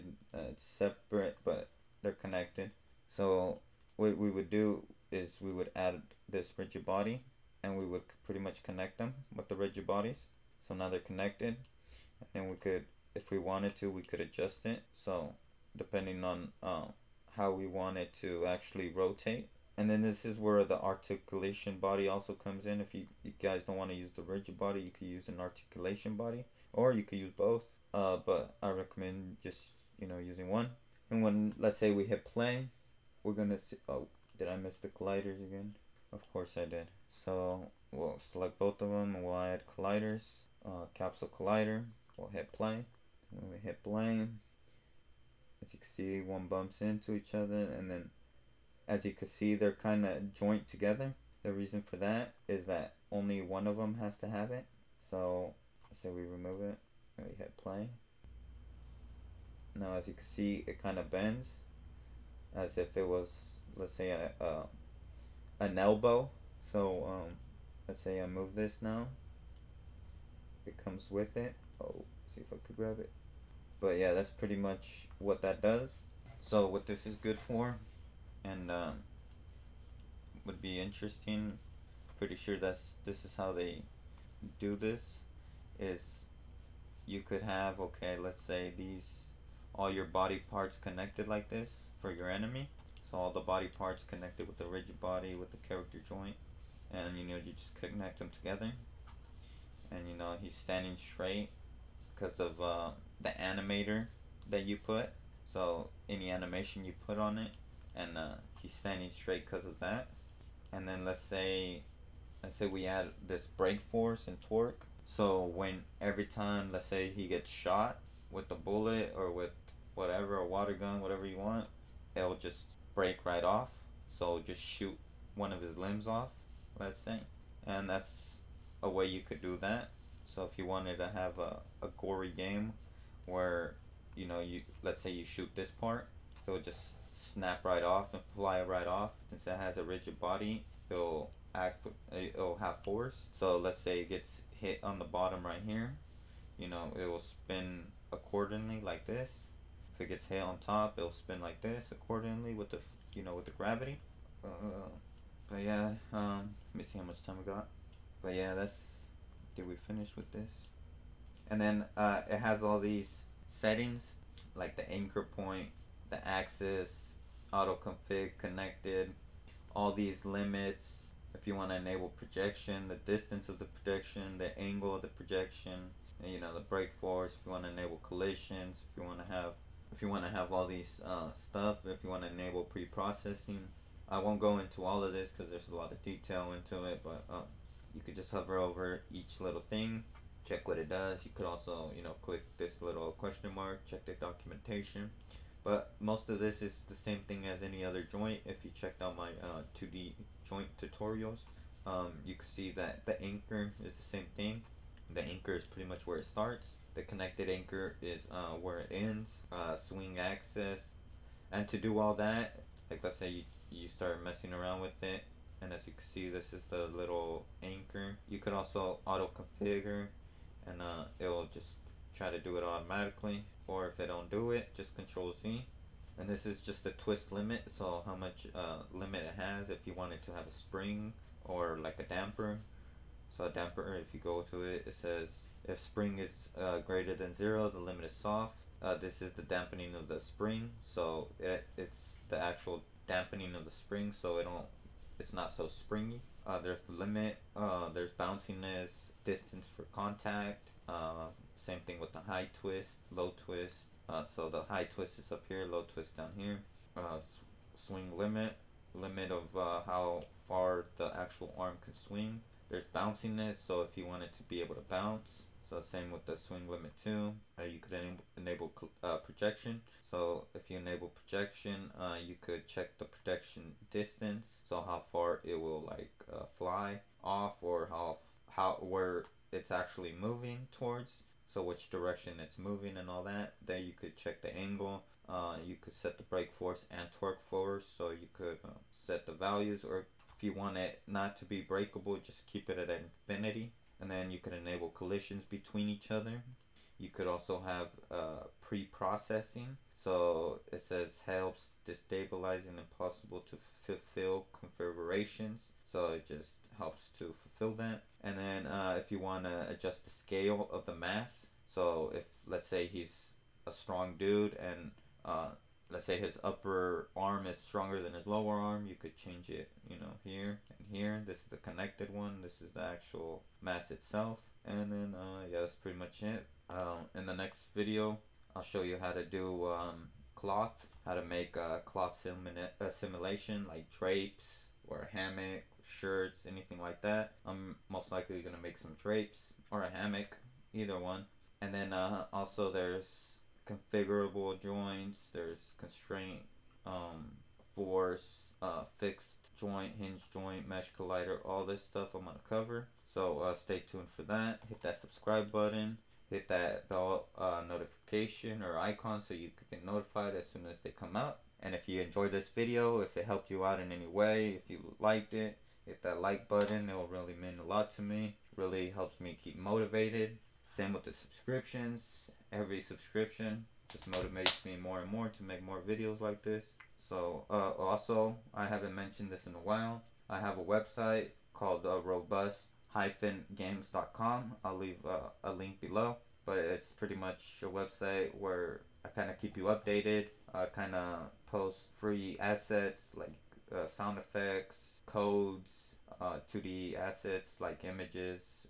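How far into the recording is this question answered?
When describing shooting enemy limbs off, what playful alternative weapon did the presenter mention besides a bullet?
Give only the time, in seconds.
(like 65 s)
120 s.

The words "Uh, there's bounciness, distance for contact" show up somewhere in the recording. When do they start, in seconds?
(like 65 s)
247 s.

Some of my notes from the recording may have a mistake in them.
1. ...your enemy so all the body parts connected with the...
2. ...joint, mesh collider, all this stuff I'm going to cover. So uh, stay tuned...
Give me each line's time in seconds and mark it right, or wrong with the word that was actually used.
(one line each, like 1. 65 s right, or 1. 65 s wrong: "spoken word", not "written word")
1. 92 s right
2. 350 s right.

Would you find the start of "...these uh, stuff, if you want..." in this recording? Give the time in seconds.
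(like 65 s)
180 s.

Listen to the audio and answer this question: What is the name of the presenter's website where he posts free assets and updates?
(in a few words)
robust-games.com.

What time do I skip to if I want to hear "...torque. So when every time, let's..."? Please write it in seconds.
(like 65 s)
114 s.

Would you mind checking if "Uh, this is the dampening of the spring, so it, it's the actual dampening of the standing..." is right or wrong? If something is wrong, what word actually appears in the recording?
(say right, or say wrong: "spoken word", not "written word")
wrong: "spring", not "standing".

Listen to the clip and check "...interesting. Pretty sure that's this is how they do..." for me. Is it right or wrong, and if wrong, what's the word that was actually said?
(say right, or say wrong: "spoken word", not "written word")
right.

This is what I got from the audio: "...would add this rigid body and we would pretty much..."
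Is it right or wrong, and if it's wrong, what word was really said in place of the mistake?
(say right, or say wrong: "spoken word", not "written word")
right.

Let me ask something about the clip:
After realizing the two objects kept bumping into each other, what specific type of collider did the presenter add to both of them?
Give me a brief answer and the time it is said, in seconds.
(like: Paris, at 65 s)
capsule collider, at 40 s.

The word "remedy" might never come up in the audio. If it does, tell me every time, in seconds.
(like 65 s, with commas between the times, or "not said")
not said.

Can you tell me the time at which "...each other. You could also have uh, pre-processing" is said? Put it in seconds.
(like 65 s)
295 s.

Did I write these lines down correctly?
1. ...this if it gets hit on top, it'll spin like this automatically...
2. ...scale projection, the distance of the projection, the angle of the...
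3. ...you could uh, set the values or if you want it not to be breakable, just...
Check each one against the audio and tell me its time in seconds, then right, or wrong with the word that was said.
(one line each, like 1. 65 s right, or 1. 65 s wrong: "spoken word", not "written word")
1. 149 s wrong: "accordingly", not "automatically"
2. 171 s wrong: "enable", not "scale"
3. 288 s right.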